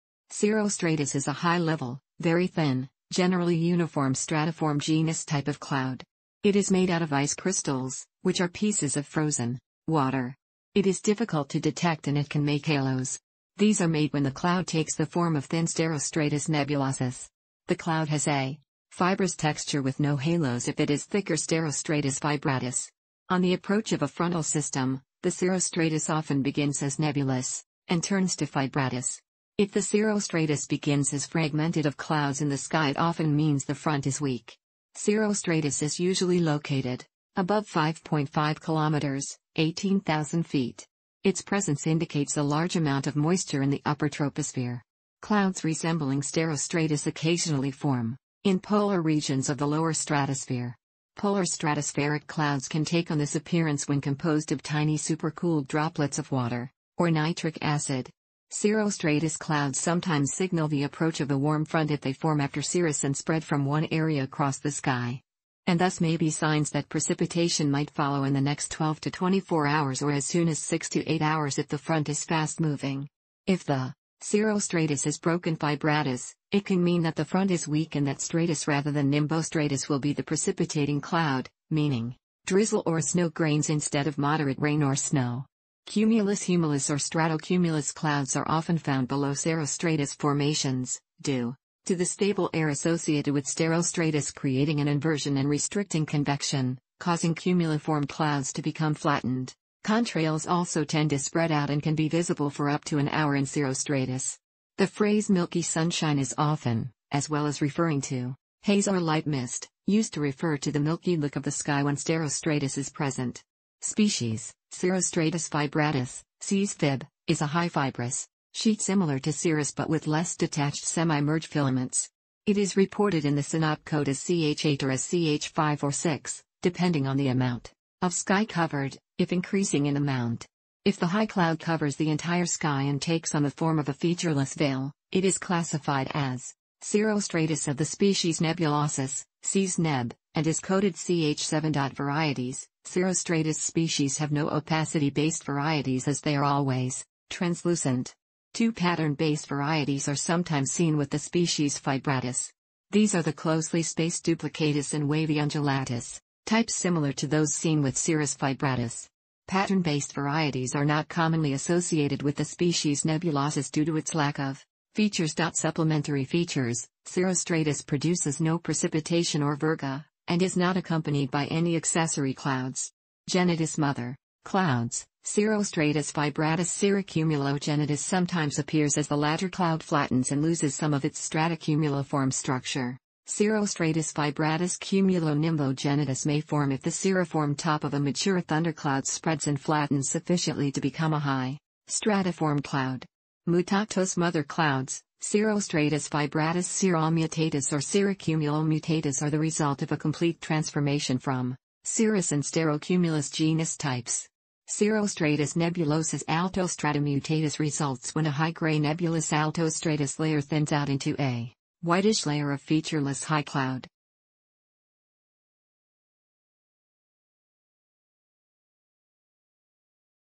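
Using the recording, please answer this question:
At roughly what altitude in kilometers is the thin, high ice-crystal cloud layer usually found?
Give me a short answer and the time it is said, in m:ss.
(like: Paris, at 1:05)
5.5 kilometers, at 0:37.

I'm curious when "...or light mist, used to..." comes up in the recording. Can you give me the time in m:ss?
1:48.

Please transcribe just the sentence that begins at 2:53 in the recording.
Genitus mother, clouds, Cirrostratus fibratus cirrocumulogenitus sometimes appears as the latter cloud flattens and loses some of its stratocumuliform structure.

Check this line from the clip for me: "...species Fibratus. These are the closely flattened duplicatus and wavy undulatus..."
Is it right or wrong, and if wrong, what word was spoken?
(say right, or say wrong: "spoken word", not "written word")
wrong: "spaced", not "flattened".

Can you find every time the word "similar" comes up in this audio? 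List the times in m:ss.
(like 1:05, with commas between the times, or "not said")
1:58, 2:36.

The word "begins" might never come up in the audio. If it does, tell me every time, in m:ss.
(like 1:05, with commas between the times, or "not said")
0:26, 0:30.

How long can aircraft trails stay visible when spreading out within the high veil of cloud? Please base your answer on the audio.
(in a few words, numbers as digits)
up to an hour.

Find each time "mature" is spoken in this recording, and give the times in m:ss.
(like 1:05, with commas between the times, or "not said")
3:07.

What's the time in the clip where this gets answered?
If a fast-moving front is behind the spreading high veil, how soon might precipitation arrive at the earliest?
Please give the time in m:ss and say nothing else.
1:10.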